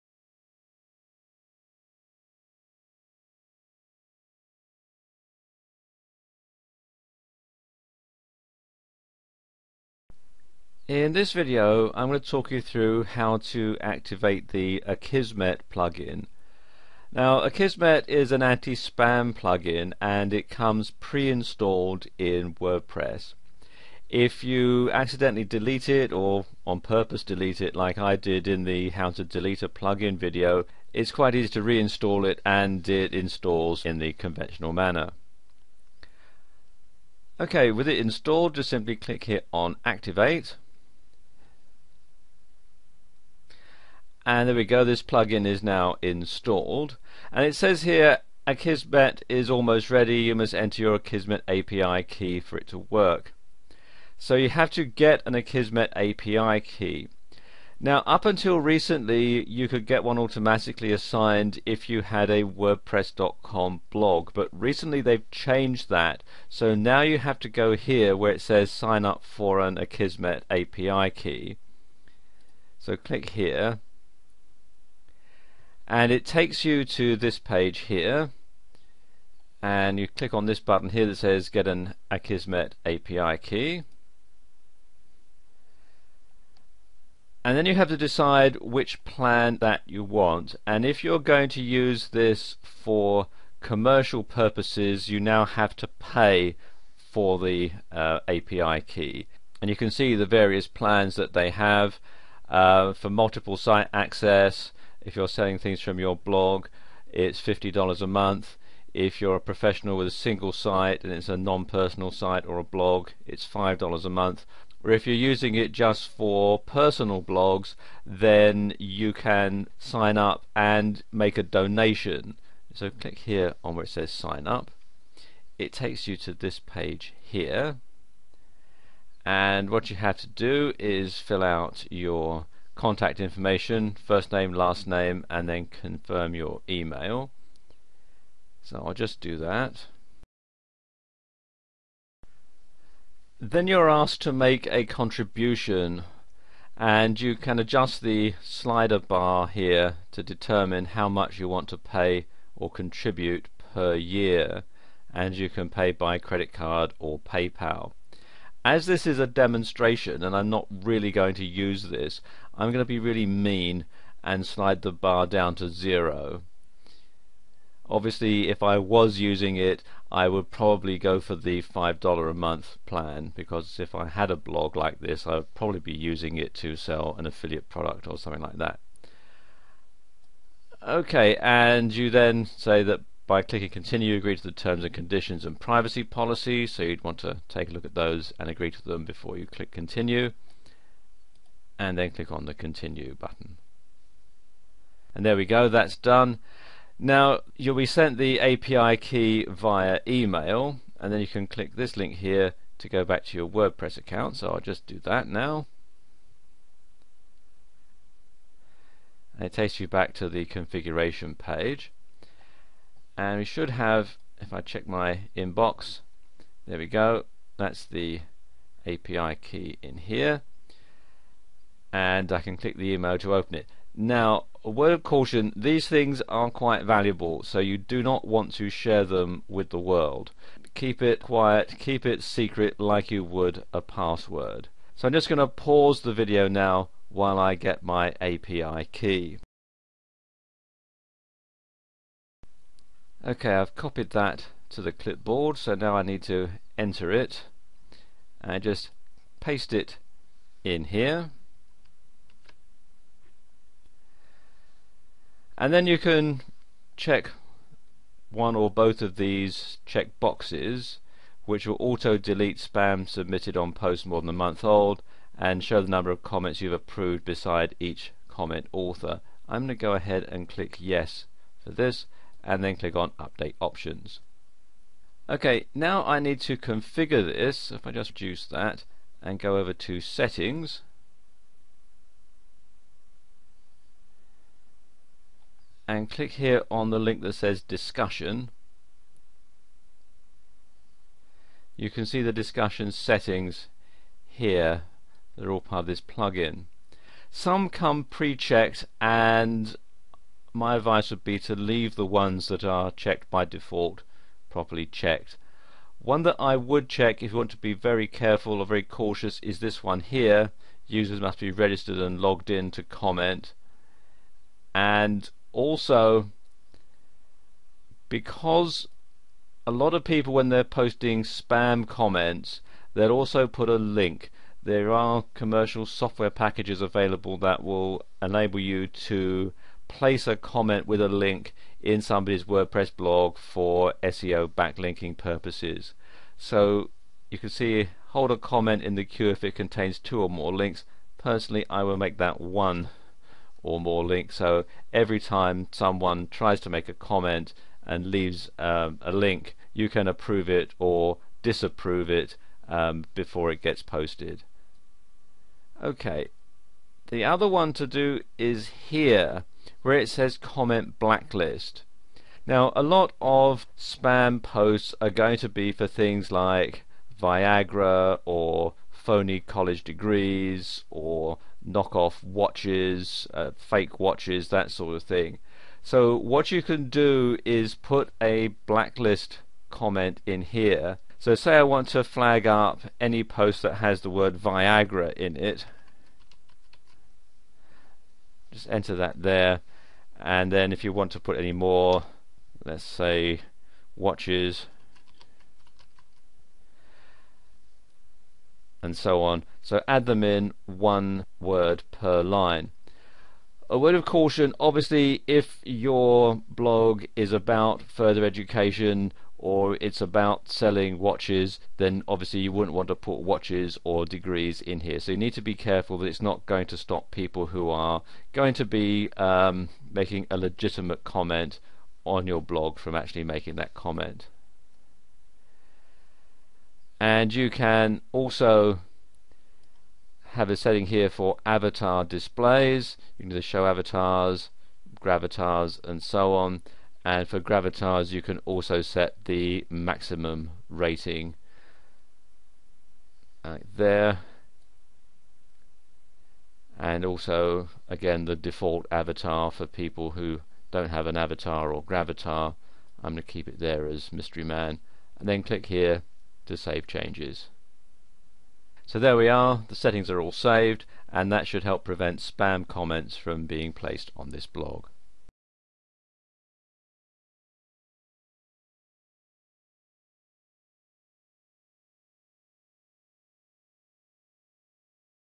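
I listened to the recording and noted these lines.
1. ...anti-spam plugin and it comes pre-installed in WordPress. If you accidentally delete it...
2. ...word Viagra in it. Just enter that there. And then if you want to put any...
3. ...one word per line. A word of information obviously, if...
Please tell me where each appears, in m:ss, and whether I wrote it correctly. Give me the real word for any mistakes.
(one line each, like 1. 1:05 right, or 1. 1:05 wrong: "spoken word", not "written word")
1. 0:18 right
2. 6:24 right
3. 6:40 wrong: "caution", not "information".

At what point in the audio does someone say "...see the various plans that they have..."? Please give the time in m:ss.
1:39.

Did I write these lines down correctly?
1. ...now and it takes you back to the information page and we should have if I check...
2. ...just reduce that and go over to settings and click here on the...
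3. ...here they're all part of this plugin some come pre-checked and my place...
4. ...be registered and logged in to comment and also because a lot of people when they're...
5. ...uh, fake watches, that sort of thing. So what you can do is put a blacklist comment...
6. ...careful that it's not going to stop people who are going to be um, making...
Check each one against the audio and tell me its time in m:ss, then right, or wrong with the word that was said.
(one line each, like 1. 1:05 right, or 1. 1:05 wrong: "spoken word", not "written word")
1. 3:25 wrong: "configuration", not "information"
2. 4:37 right
3. 4:54 wrong: "advice", not "place"
4. 5:11 right
5. 6:13 right
6. 6:55 right.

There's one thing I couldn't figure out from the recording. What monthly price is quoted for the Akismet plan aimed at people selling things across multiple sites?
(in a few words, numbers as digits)
$50 a month.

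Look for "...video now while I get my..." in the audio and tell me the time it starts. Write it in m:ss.
3:56.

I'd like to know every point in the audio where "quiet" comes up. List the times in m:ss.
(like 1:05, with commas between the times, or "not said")
3:51.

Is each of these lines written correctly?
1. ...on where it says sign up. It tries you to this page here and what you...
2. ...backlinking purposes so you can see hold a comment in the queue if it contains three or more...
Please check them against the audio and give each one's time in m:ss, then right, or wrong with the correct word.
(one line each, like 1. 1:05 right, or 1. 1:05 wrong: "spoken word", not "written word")
1. 2:03 wrong: "takes", not "tries"
2. 5:34 wrong: "two", not "three".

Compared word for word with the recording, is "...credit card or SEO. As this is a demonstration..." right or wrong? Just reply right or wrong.
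wrong.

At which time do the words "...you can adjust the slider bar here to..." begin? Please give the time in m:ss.
2:27.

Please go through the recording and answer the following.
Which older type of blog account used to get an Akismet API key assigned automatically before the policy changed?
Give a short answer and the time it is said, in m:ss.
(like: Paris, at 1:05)
wordpress.com blog, at 1:02.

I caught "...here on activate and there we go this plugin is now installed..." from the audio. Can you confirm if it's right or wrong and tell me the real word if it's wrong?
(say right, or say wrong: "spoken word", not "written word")
right.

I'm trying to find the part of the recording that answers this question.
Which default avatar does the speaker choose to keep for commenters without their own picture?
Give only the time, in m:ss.
7:34.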